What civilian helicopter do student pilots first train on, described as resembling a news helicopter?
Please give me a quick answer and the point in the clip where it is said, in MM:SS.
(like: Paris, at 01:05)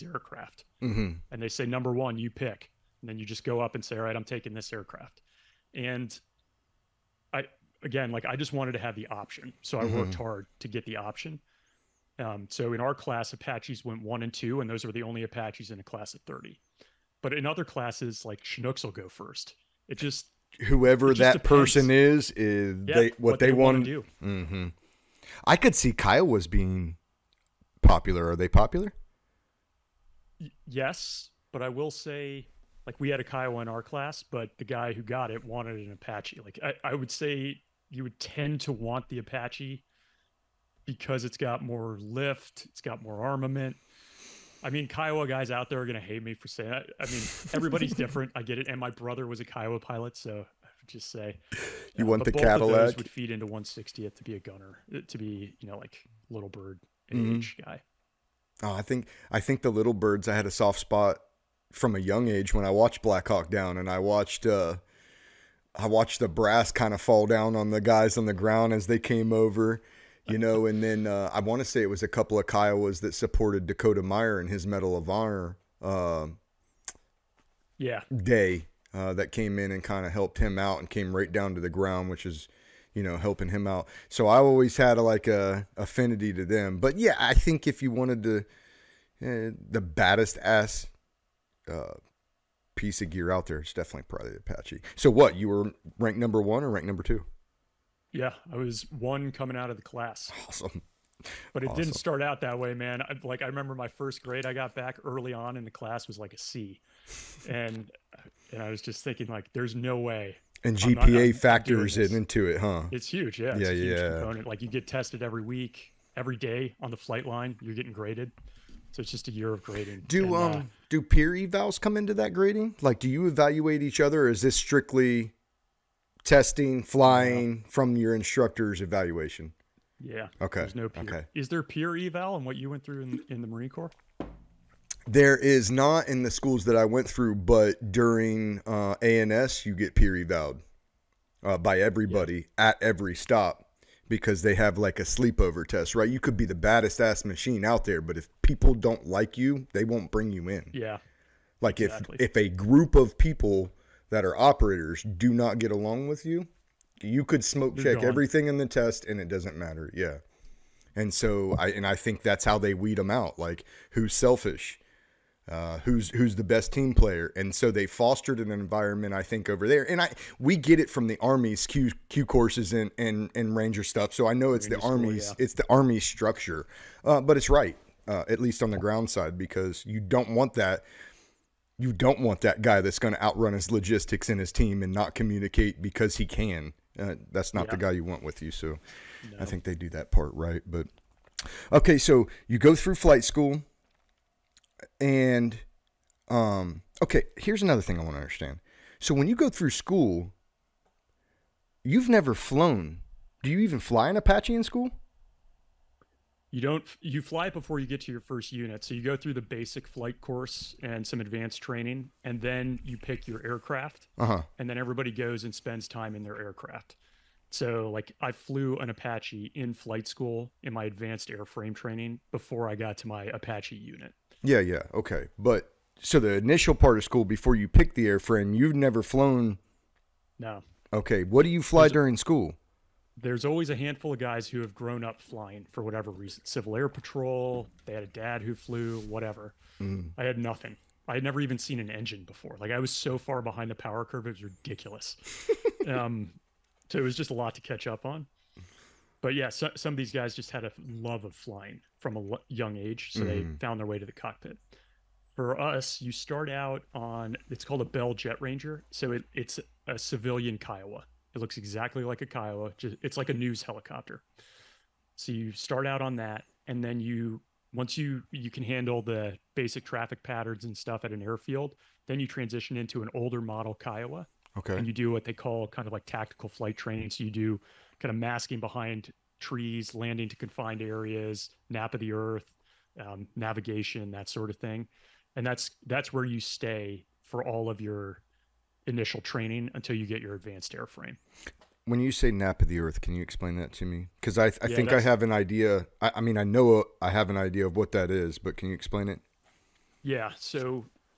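Bell Jet Ranger, at 04:17.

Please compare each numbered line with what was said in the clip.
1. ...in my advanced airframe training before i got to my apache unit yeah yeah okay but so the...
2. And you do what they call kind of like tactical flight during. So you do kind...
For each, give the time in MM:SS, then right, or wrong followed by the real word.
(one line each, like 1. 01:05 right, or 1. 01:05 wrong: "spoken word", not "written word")
1. 03:40 right
2. 04:34 wrong: "training", not "during".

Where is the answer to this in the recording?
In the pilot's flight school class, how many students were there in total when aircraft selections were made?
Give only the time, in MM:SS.
00:15.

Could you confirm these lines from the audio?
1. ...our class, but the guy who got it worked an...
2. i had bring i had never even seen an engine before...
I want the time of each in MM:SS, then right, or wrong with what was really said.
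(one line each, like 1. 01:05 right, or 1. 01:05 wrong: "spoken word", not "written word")
1. 00:33 wrong: "wanted", not "worked"
2. 04:00 wrong: "nothing", not "bring".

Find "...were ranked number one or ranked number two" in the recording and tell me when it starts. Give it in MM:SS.
01:35.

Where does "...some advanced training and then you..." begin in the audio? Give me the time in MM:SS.
03:31.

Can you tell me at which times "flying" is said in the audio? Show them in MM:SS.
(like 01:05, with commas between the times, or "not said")
02:06, 03:55, 04:11.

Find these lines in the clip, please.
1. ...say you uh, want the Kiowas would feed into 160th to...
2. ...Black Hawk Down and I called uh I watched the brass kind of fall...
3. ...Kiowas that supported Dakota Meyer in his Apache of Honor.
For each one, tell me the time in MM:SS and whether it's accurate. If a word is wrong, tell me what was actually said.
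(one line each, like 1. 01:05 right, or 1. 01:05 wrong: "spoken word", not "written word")
1. 00:51 wrong: "Cadillac", not "Kiowas"
2. 01:03 wrong: "watched", not "called"
3. 01:12 wrong: "Medal", not "Apache".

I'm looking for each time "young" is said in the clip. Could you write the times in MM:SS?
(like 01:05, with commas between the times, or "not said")
01:01, 04:12.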